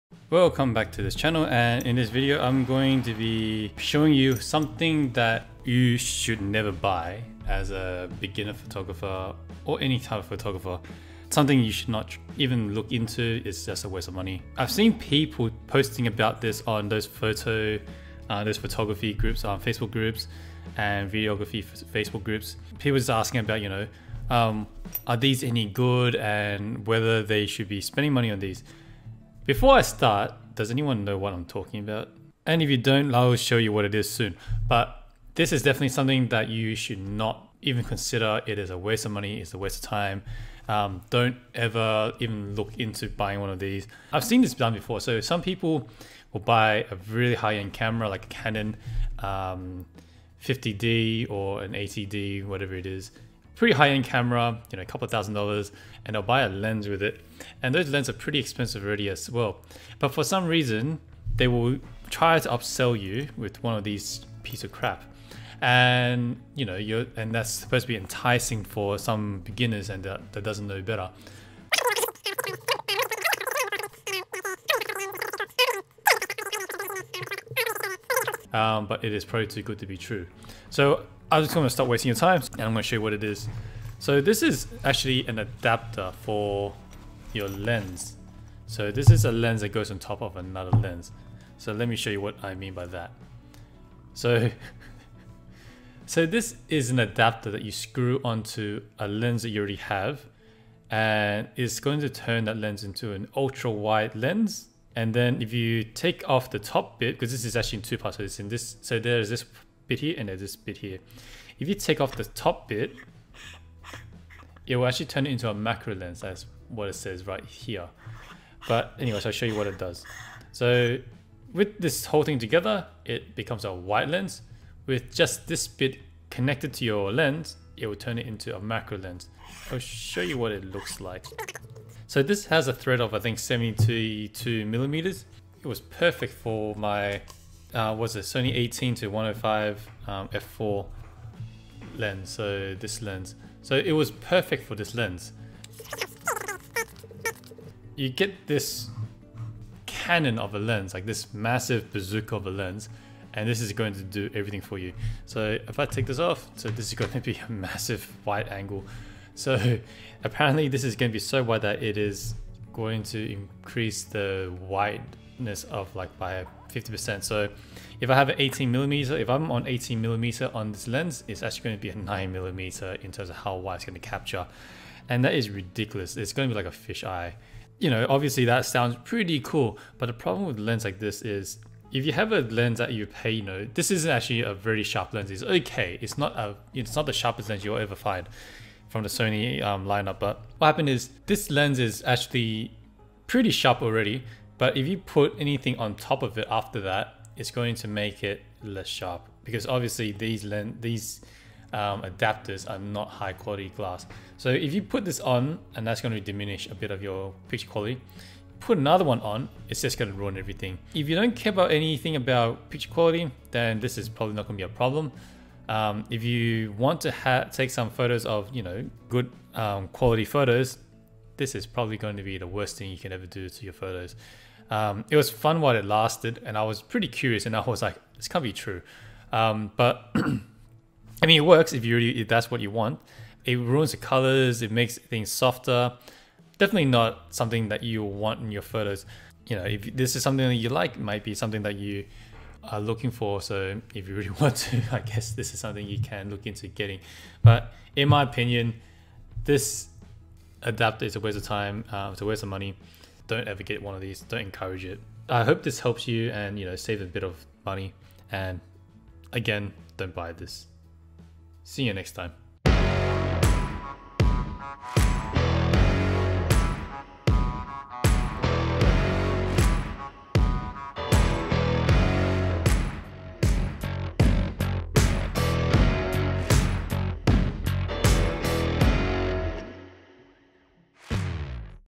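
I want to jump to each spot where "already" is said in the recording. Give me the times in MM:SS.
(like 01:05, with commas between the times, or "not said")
00:58, 01:39, 03:13.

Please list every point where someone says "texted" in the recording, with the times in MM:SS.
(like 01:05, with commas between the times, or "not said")
not said.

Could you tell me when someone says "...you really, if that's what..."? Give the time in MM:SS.
03:51.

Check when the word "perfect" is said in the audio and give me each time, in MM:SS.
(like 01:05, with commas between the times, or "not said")
02:15, 02:24.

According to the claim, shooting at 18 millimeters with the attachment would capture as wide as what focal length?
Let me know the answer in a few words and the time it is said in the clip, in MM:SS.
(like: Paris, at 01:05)
9 millimeter, at 02:51.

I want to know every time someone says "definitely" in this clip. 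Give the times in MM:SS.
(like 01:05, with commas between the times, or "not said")
00:35, 03:56.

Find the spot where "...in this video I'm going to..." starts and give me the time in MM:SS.
00:01.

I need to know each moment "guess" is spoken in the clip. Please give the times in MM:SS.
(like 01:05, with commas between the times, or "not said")
04:04.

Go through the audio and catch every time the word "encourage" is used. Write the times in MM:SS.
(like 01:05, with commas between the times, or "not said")
04:14.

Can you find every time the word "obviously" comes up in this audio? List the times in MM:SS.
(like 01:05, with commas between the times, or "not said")
02:58, 03:19.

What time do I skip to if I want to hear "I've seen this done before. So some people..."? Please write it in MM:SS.
00:44.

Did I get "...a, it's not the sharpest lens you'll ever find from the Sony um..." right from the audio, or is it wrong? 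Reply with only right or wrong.
right.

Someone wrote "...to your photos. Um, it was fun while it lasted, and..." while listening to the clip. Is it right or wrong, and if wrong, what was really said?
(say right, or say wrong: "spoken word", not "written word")
right.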